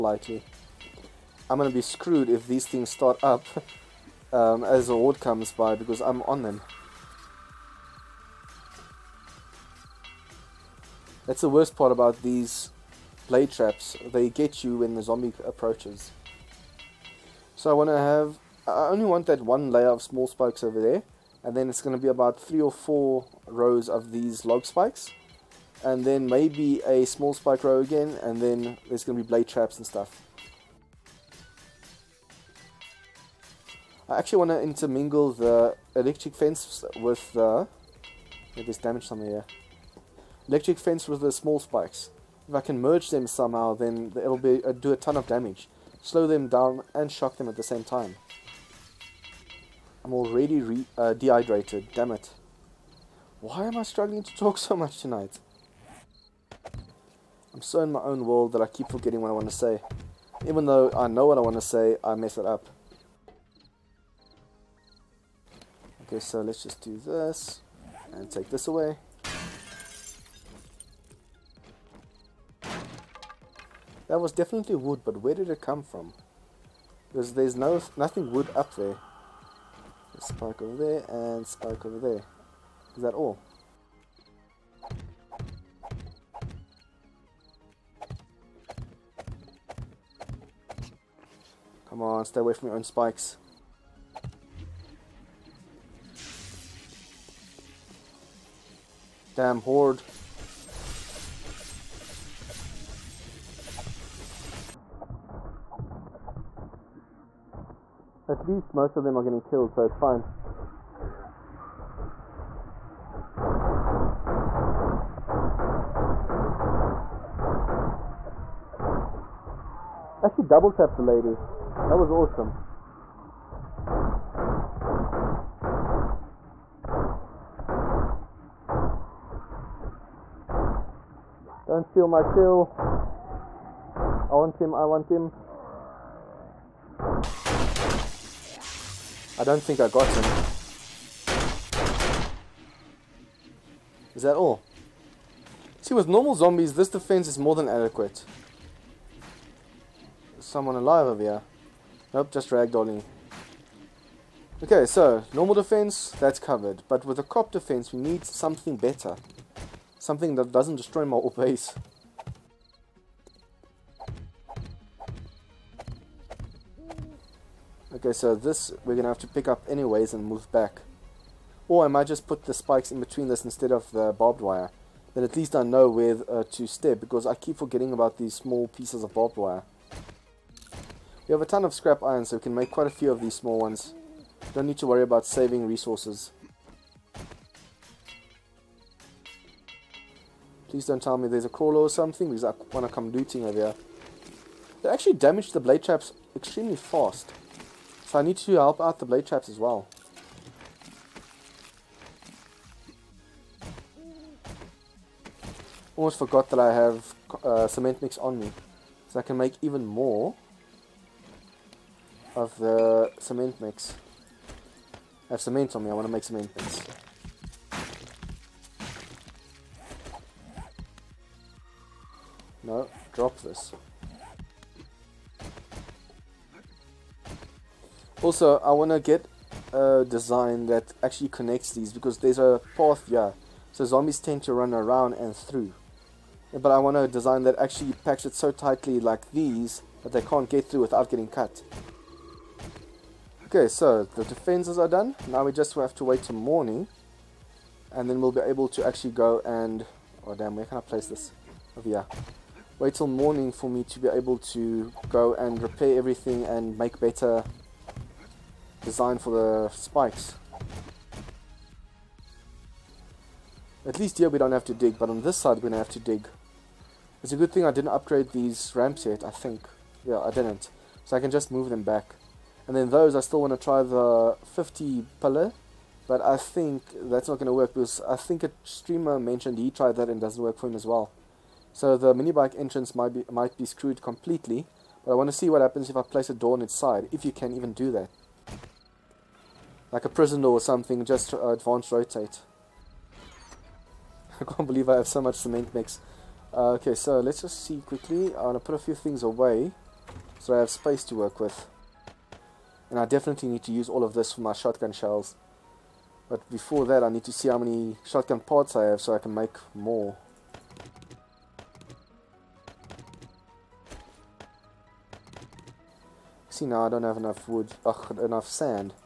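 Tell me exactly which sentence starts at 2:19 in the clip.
I don't think I got him.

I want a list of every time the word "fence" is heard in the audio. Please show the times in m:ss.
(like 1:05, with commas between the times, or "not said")
0:36, 0:40.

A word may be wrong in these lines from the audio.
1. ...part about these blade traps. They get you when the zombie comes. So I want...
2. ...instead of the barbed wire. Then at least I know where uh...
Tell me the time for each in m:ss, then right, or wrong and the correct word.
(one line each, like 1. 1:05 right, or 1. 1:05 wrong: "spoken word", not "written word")
1. 0:11 wrong: "approaches", not "comes"
2. 2:53 right.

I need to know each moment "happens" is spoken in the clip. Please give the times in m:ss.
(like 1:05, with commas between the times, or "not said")
4:45.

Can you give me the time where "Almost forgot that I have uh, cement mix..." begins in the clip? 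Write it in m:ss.
3:25.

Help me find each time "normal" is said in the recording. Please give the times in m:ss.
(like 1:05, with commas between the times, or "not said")
2:26, 2:35.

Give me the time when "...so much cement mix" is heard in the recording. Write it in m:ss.
4:55.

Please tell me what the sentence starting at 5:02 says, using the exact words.
And I definitely need to use all of this for my shotgun shells.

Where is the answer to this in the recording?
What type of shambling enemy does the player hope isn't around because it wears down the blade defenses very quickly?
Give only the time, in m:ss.
3:11.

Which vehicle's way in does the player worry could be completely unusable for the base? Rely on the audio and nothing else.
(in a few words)
mini bike.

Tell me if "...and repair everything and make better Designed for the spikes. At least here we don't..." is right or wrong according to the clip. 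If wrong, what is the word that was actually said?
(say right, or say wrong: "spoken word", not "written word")
right.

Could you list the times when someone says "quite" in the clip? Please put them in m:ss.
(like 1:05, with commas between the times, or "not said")
3:02.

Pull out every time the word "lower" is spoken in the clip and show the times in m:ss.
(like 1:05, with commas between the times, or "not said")
not said.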